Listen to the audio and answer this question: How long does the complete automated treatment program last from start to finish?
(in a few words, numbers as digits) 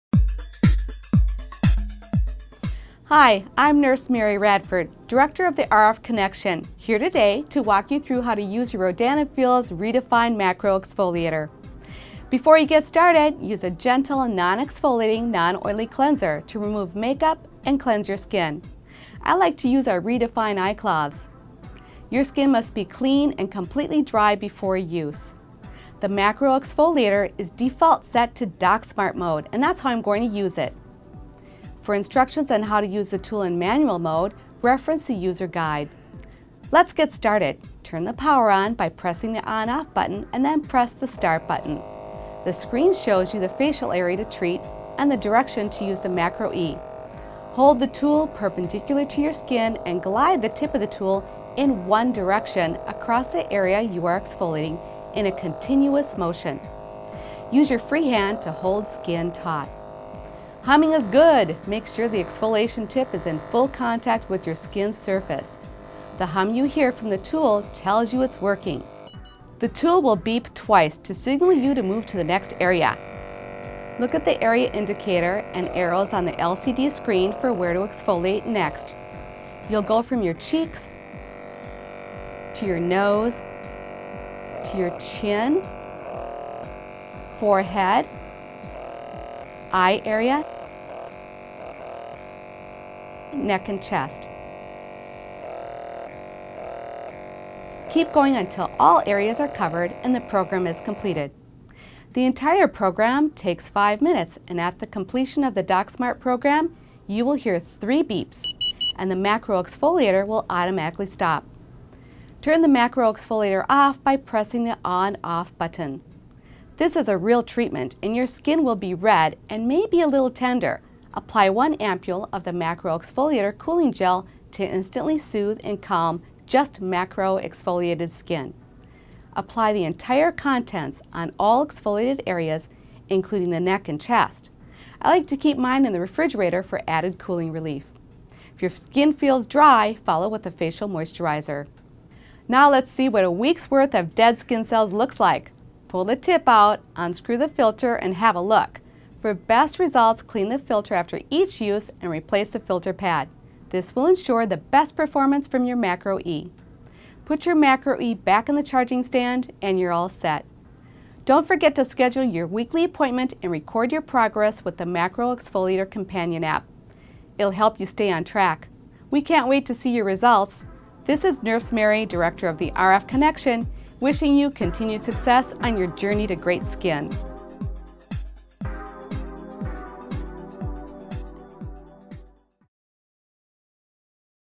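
5 minutes.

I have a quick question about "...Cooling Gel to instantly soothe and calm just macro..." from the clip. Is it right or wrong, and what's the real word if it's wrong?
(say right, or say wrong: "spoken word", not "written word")
right.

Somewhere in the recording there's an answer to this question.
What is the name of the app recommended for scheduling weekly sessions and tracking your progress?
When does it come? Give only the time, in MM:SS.
02:44.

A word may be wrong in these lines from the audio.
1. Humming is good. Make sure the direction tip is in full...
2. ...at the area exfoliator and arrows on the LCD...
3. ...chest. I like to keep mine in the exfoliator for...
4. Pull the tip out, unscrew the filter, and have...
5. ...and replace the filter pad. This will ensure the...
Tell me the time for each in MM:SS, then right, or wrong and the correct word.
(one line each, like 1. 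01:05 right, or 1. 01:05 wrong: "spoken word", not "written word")
1. 01:00 wrong: "exfoliation", not "direction"
2. 01:14 wrong: "indicator", not "exfoliator"
3. 02:13 wrong: "refrigerator", not "exfoliator"
4. 02:25 right
5. 02:32 right.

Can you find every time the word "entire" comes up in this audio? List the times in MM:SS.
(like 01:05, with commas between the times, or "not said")
01:42, 02:09.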